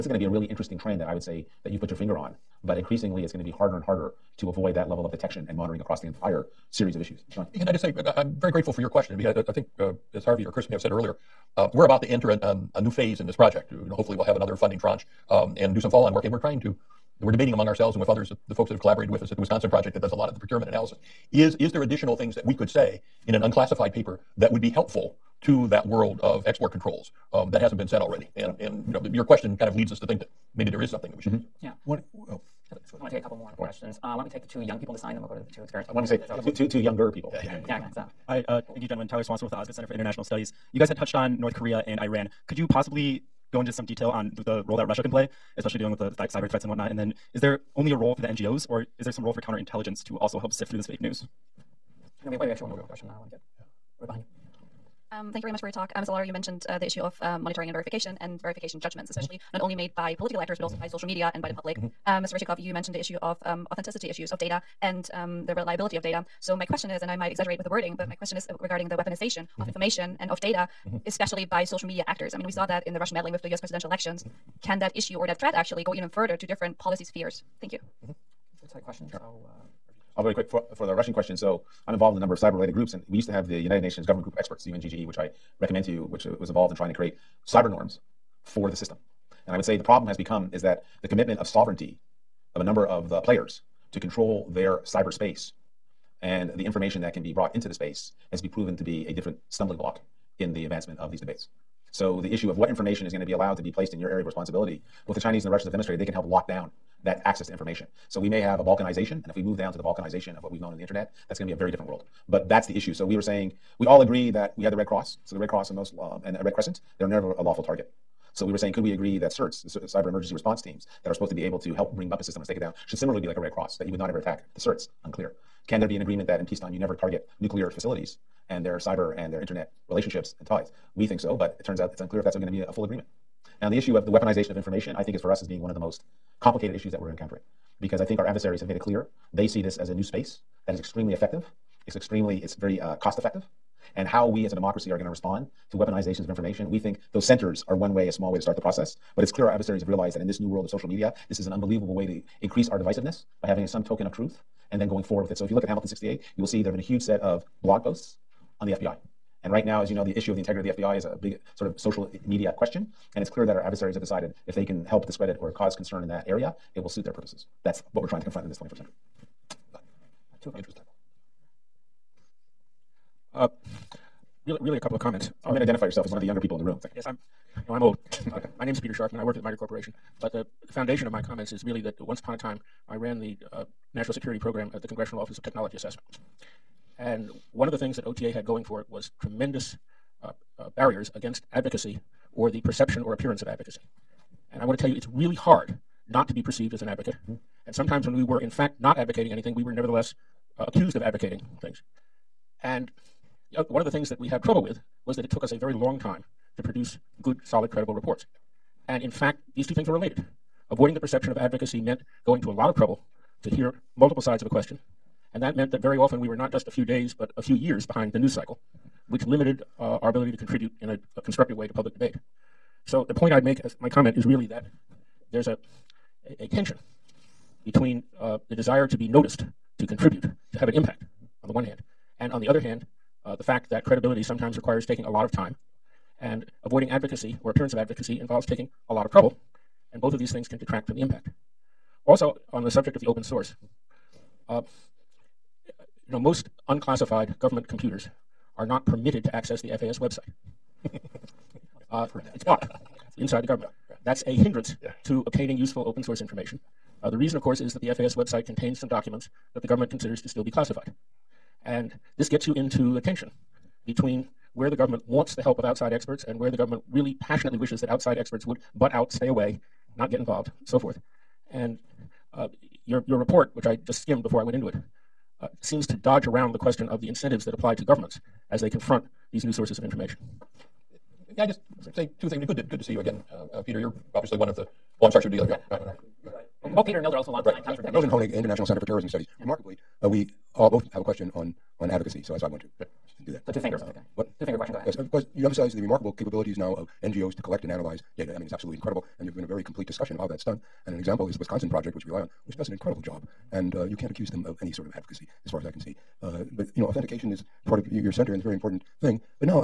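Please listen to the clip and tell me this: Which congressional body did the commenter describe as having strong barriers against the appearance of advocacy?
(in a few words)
Office of Technology Assessment.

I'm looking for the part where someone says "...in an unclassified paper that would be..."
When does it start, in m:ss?
0:23.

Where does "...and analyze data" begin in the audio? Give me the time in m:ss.
4:57.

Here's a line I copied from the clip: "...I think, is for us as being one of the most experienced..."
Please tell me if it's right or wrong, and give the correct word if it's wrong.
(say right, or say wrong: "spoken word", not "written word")
wrong: "complicated", not "experienced".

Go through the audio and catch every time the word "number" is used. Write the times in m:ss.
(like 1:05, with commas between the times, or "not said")
1:22, 1:32.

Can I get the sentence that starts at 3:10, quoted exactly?
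Uh, barriers against advocacy or the perception or appearance of advocacy.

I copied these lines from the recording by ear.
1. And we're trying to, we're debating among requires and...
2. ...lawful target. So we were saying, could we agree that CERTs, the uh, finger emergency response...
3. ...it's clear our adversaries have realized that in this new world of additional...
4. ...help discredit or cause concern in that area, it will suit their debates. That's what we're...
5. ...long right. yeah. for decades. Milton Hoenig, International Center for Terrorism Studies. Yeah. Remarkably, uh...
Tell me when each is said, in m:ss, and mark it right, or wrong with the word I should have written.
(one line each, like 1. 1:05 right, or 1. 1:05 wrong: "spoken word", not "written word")
1. 0:16 wrong: "ourselves", not "requires"
2. 1:57 wrong: "cyber", not "finger"
3. 2:29 wrong: "social", not "additional"
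4. 2:44 wrong: "purposes", not "debates"
5. 4:47 right.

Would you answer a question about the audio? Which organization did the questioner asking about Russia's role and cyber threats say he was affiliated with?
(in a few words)
Osgood Center for International Studies.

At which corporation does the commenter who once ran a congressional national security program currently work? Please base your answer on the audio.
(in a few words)
MITRE Corporation.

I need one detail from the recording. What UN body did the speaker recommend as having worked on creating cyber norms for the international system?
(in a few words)
United Nations Government Group of Experts.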